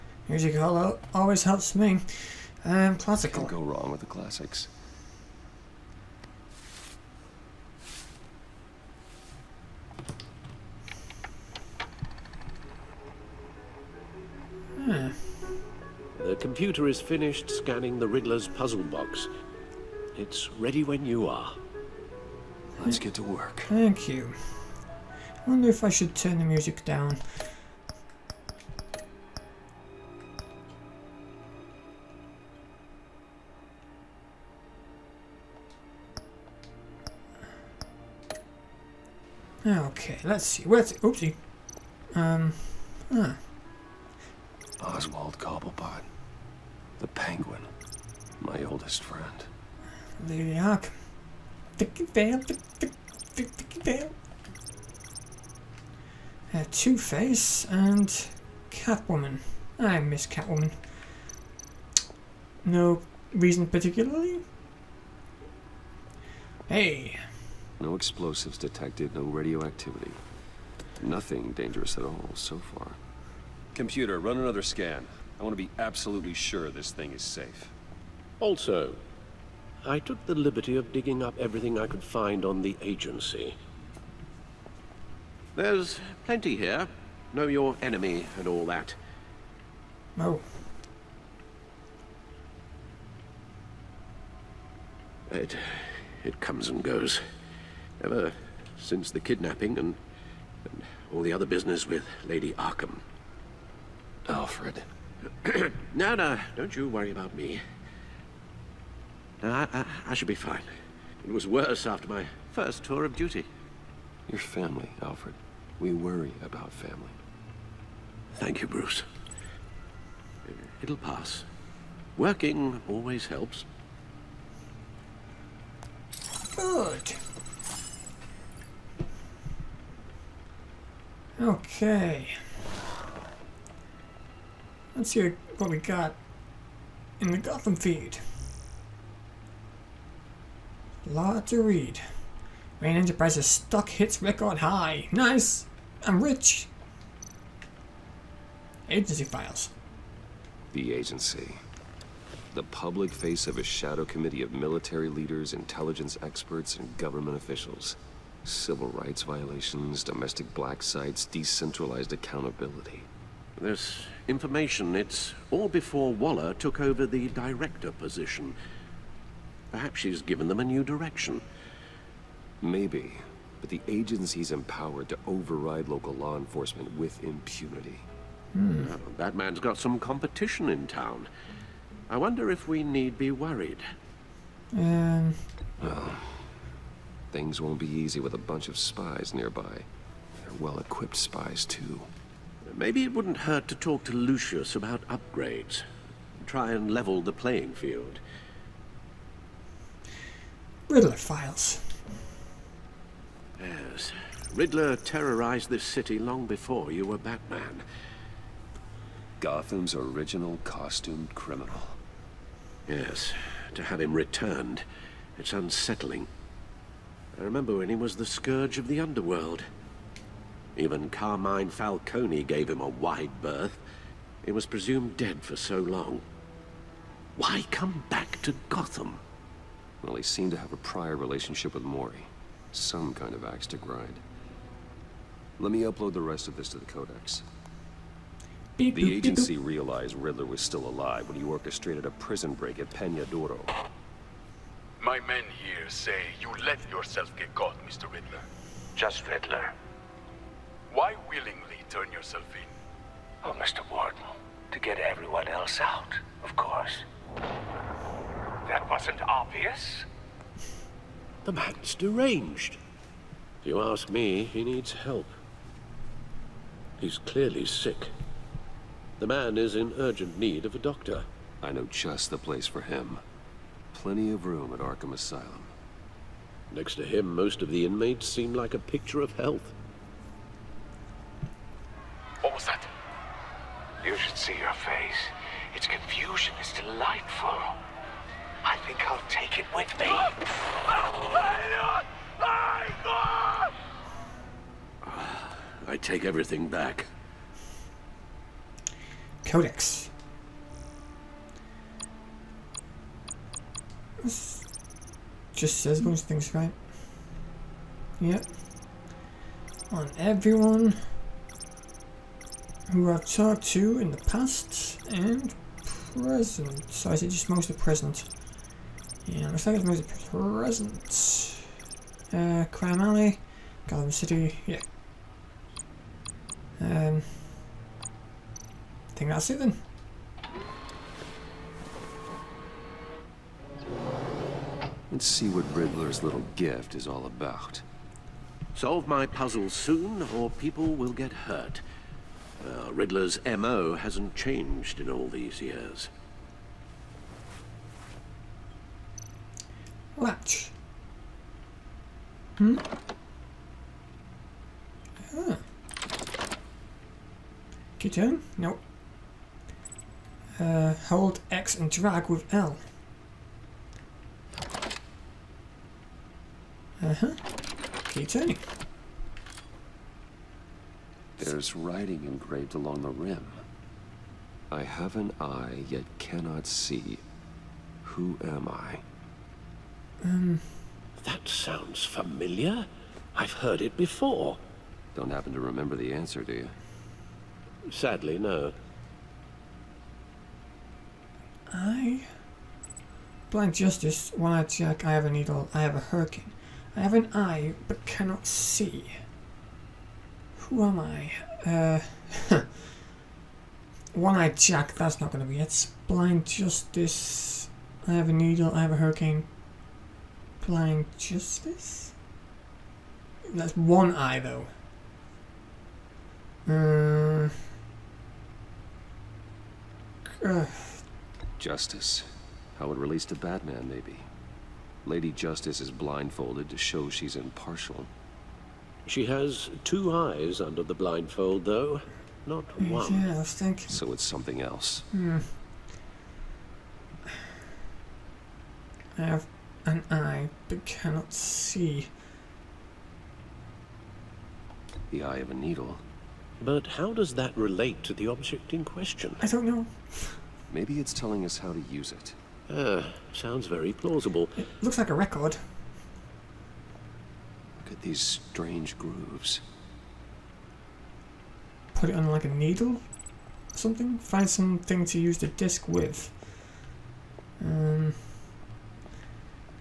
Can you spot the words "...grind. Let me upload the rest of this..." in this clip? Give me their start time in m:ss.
3:53.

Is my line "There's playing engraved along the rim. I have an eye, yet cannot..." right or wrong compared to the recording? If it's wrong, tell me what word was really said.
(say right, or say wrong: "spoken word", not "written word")
wrong: "writing", not "playing".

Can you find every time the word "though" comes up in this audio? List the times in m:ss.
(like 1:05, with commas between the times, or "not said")
6:54, 7:11.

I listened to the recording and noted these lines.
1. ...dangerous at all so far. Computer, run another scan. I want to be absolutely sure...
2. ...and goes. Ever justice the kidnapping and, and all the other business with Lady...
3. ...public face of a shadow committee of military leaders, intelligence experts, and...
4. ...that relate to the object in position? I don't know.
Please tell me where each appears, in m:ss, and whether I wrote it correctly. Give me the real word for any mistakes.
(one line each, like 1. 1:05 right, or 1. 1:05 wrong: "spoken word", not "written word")
1. 1:11 right
2. 1:36 wrong: "since", not "justice"
3. 2:32 right
4. 7:27 wrong: "question", not "position".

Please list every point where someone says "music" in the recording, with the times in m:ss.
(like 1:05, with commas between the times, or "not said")
0:00, 0:26.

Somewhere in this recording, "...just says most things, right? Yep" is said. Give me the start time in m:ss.
5:05.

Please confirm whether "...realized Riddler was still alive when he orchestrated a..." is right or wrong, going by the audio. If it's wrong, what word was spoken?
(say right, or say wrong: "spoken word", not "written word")
right.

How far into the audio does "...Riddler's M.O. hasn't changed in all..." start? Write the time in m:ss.
5:42.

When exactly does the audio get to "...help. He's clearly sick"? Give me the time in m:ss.
4:24.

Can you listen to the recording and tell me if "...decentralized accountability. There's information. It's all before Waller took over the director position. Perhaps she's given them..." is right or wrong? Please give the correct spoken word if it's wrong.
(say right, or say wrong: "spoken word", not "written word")
right.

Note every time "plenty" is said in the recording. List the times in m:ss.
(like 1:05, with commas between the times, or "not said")
1:26, 4:33.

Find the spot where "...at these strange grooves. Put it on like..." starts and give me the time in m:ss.
7:37.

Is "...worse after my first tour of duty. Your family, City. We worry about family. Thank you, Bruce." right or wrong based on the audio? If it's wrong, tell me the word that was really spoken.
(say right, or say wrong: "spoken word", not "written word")
wrong: "Alfred", not "City".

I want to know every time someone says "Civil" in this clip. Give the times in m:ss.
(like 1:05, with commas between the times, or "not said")
2:38.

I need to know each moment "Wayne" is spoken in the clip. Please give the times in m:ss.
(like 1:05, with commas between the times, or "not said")
2:22.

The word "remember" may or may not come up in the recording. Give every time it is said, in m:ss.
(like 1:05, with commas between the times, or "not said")
3:37, 6:25.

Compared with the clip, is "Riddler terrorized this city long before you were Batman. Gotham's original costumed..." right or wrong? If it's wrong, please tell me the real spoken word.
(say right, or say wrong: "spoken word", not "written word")
right.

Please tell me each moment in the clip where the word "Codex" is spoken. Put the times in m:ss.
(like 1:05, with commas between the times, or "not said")
3:56, 4:59.